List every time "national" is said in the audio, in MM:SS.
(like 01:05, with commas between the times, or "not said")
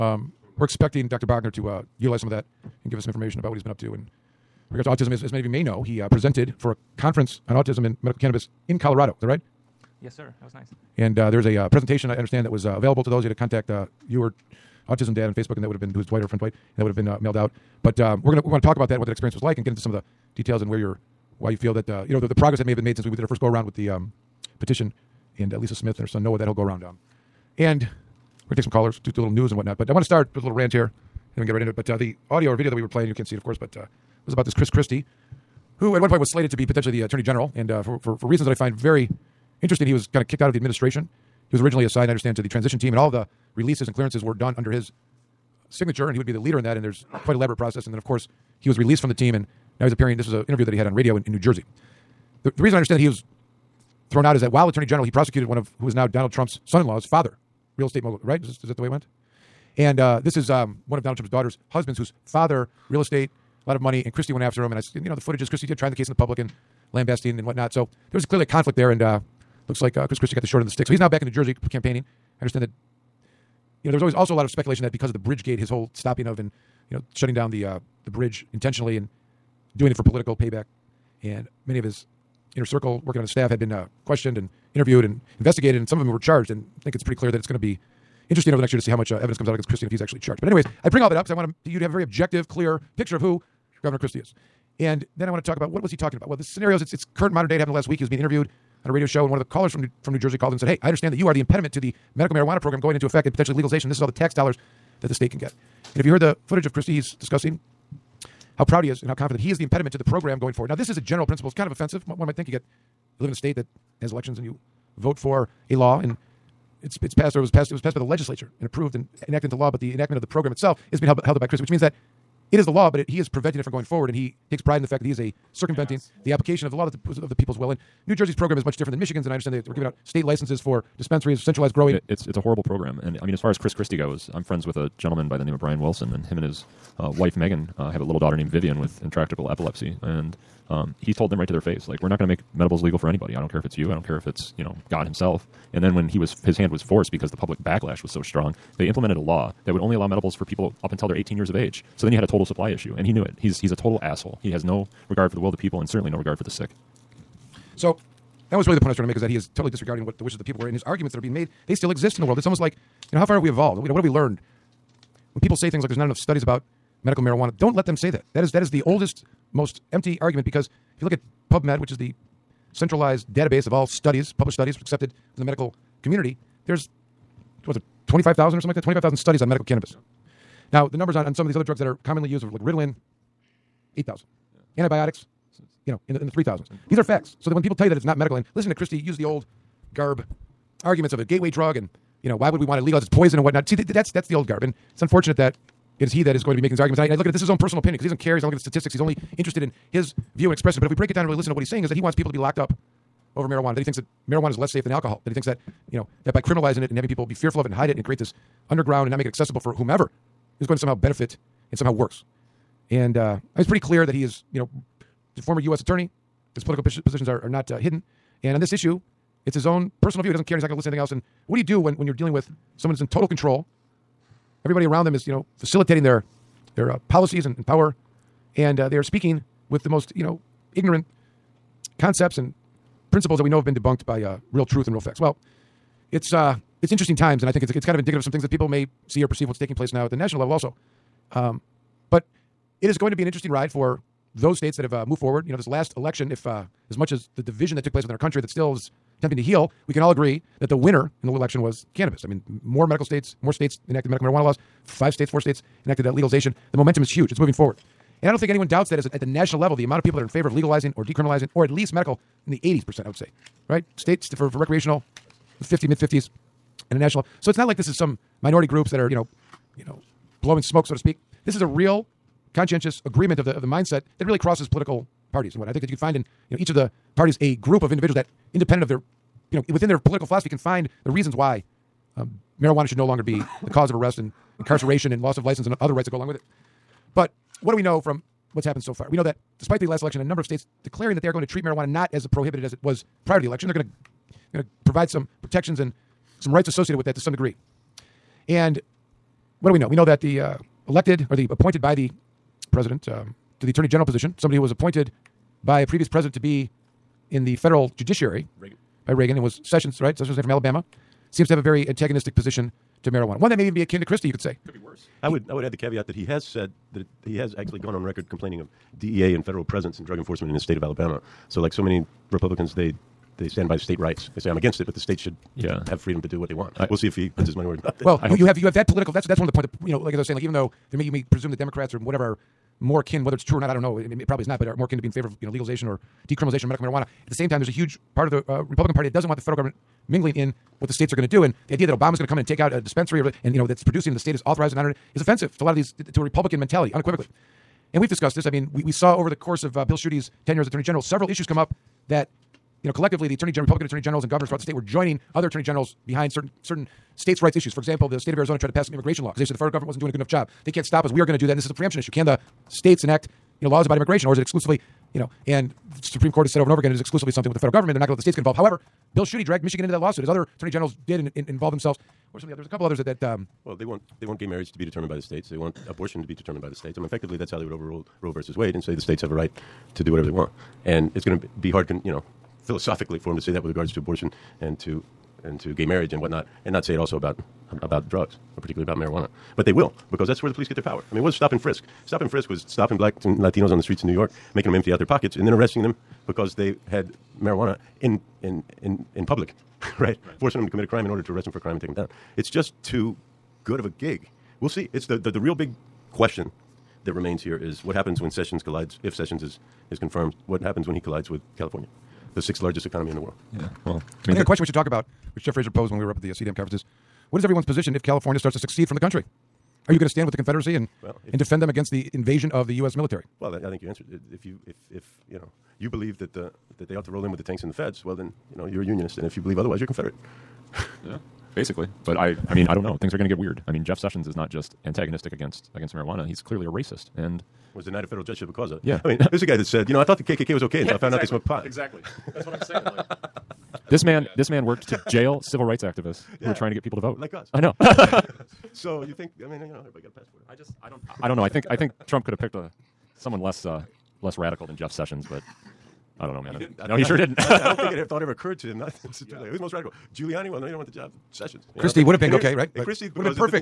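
04:00, 04:19, 04:26.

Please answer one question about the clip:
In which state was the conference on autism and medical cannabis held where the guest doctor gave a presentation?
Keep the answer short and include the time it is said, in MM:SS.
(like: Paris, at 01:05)
Colorado, at 00:08.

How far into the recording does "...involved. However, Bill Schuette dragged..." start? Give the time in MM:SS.
06:08.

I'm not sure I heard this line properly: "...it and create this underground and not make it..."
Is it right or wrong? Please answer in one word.
right.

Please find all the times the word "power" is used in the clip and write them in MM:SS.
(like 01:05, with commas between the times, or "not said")
03:47, 06:30.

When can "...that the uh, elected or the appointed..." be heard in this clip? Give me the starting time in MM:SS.
05:00.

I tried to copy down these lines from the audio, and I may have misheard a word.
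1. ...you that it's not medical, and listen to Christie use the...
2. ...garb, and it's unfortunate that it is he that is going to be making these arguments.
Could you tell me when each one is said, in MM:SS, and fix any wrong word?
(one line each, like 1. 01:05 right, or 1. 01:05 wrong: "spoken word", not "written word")
1. 03:07 right
2. 03:14 right.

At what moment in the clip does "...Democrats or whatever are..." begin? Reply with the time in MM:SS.
05:31.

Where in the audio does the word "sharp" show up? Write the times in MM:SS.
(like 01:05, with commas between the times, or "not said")
not said.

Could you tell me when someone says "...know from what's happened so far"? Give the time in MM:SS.
04:47.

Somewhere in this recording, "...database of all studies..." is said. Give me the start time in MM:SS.
02:53.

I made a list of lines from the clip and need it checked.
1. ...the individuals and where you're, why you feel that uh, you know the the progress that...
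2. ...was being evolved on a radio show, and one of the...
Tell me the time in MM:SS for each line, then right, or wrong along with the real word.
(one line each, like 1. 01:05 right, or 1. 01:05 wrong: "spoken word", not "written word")
1. 00:19 wrong: "details", not "individuals"
2. 01:38 wrong: "interviewed", not "evolved".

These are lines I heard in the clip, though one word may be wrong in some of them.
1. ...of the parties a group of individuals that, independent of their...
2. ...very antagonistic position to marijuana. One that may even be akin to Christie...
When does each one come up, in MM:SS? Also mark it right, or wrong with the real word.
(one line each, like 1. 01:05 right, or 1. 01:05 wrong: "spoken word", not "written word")
1. 04:36 right
2. 05:11 right.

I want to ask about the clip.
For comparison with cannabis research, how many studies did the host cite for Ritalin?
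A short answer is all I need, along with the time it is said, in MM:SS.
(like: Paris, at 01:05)
8,000, at 03:03.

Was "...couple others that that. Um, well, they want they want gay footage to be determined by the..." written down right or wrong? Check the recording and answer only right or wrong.
wrong.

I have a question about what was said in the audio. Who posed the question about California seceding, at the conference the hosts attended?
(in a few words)
Jeff Frazier.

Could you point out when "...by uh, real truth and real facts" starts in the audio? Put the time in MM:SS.
03:54.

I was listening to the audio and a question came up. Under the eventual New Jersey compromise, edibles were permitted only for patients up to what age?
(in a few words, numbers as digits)
18.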